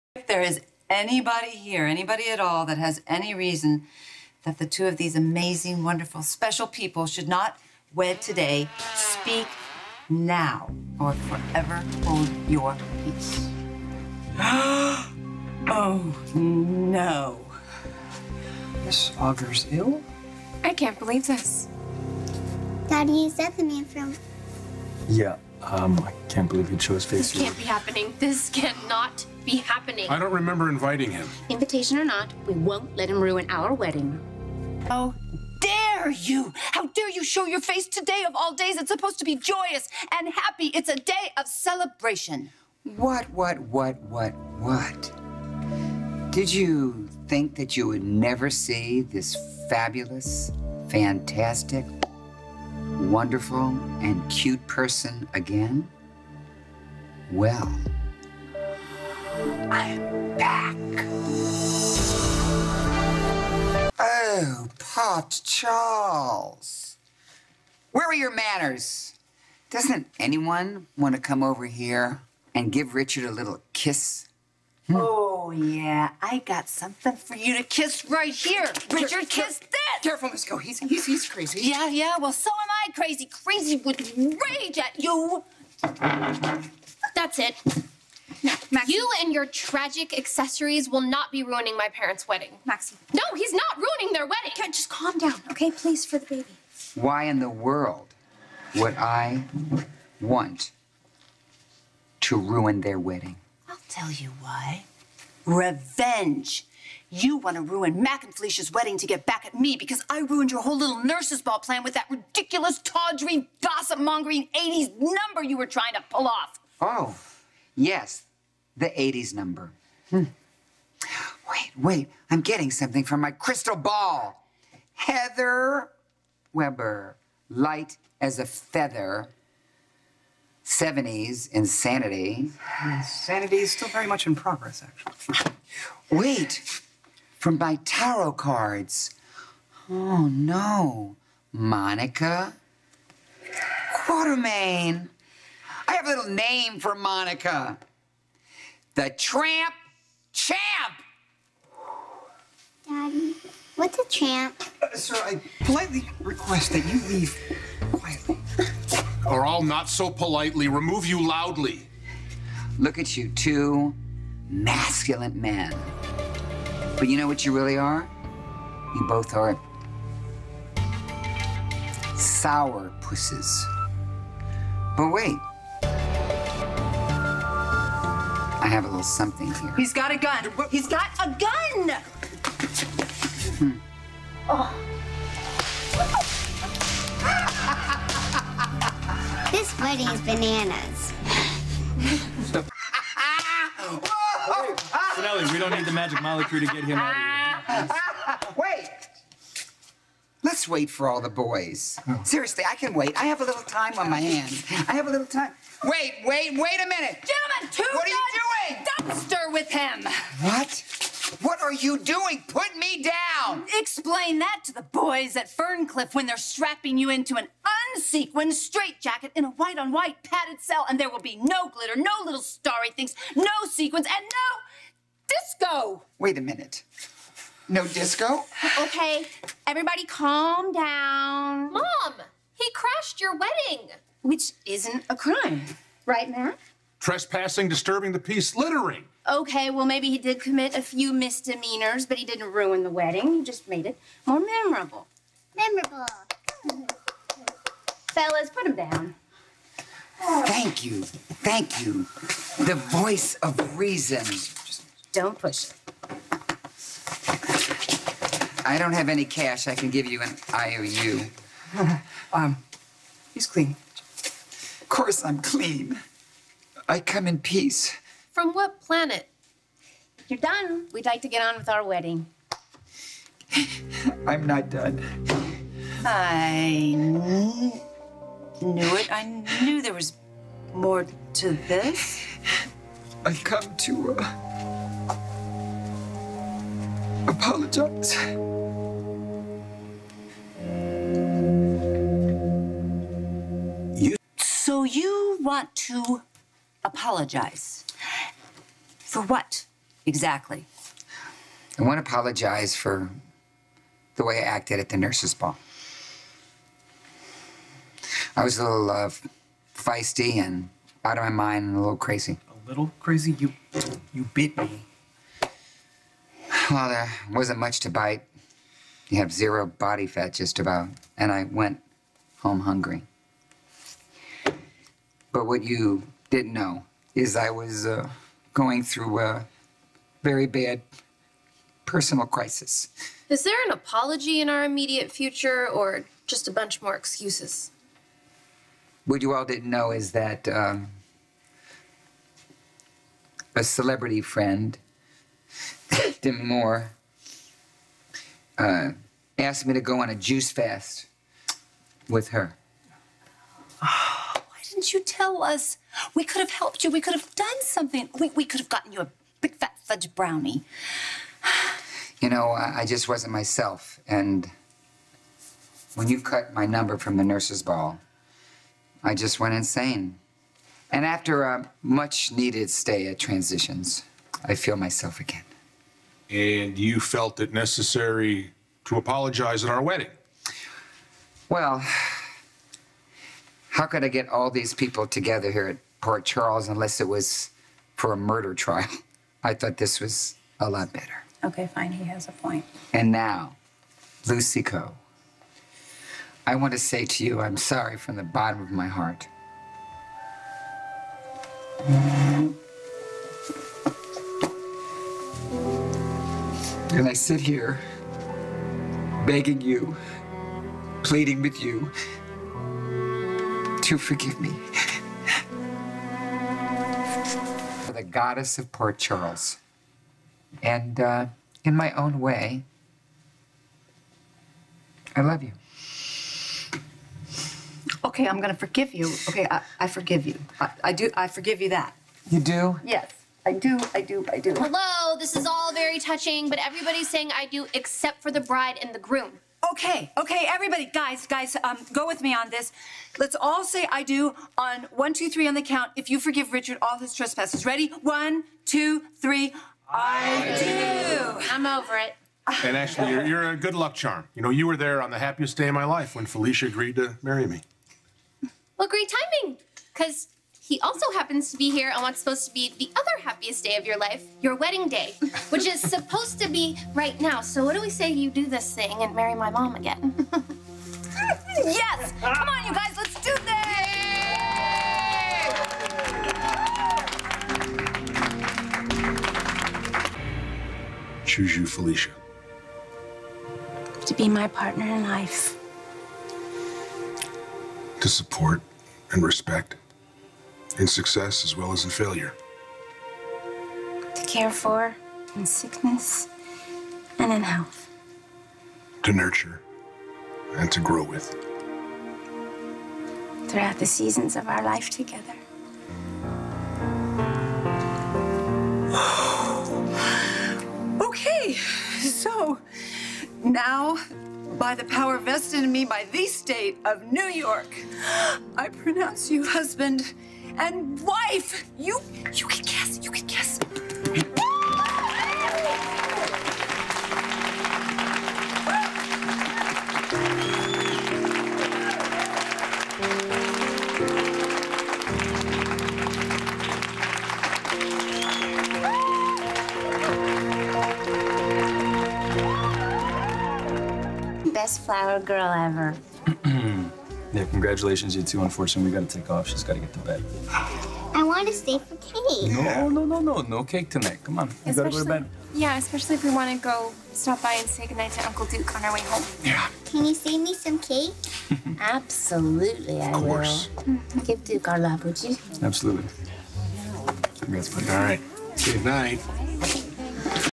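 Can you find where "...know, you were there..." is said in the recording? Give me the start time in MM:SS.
07:34.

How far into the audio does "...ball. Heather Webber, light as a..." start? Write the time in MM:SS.
02:03.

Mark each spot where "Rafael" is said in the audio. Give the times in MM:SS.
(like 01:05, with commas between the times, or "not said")
not said.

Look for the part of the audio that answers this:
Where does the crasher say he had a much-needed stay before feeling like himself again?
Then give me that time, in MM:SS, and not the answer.
06:13.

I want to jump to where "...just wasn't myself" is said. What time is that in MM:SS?
06:02.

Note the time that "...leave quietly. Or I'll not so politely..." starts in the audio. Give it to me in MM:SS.
02:37.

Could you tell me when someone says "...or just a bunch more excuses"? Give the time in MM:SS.
05:35.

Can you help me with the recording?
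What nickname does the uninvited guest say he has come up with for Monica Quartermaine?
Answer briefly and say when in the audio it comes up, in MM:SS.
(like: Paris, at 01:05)
The Tramp Champ, at 02:28.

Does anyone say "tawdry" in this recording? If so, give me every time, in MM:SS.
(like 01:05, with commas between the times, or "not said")
01:52.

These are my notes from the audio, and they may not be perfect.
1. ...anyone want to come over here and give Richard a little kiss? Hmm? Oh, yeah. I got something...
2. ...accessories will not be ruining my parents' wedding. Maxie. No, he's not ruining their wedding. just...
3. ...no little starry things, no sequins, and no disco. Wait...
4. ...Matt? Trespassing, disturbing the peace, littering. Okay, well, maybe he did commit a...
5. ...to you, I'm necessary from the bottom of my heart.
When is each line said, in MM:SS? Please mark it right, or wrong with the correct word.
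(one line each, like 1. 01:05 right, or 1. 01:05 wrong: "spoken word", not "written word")
1. 01:10 right
2. 01:30 right
3. 03:41 right
4. 03:56 right
5. 06:37 wrong: "sorry", not "necessary".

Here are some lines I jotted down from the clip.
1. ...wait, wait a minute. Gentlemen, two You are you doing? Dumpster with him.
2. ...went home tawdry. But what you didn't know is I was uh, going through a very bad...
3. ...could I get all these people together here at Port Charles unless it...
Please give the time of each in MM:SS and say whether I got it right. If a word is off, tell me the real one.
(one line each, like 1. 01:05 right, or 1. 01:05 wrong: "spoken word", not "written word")
1. 03:26 wrong: "What", not "You"
2. 05:21 wrong: "hungry", not "tawdry"
3. 06:23 right.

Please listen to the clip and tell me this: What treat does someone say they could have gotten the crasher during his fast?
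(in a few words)
fudge brownie.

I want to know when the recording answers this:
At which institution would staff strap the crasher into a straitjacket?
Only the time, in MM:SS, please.
03:35.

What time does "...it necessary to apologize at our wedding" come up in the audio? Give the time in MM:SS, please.
06:17.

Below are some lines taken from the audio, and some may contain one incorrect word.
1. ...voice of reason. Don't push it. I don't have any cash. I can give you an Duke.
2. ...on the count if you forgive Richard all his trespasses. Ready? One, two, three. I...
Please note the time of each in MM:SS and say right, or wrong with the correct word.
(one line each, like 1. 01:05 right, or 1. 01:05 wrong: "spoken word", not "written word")
1. 04:12 wrong: "IOU", not "Duke"
2. 07:25 right.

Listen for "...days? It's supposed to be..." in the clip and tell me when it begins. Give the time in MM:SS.
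00:38.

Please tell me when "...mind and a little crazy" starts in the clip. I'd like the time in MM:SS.
05:11.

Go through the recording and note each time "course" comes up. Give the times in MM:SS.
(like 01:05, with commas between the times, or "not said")
04:24, 09:23.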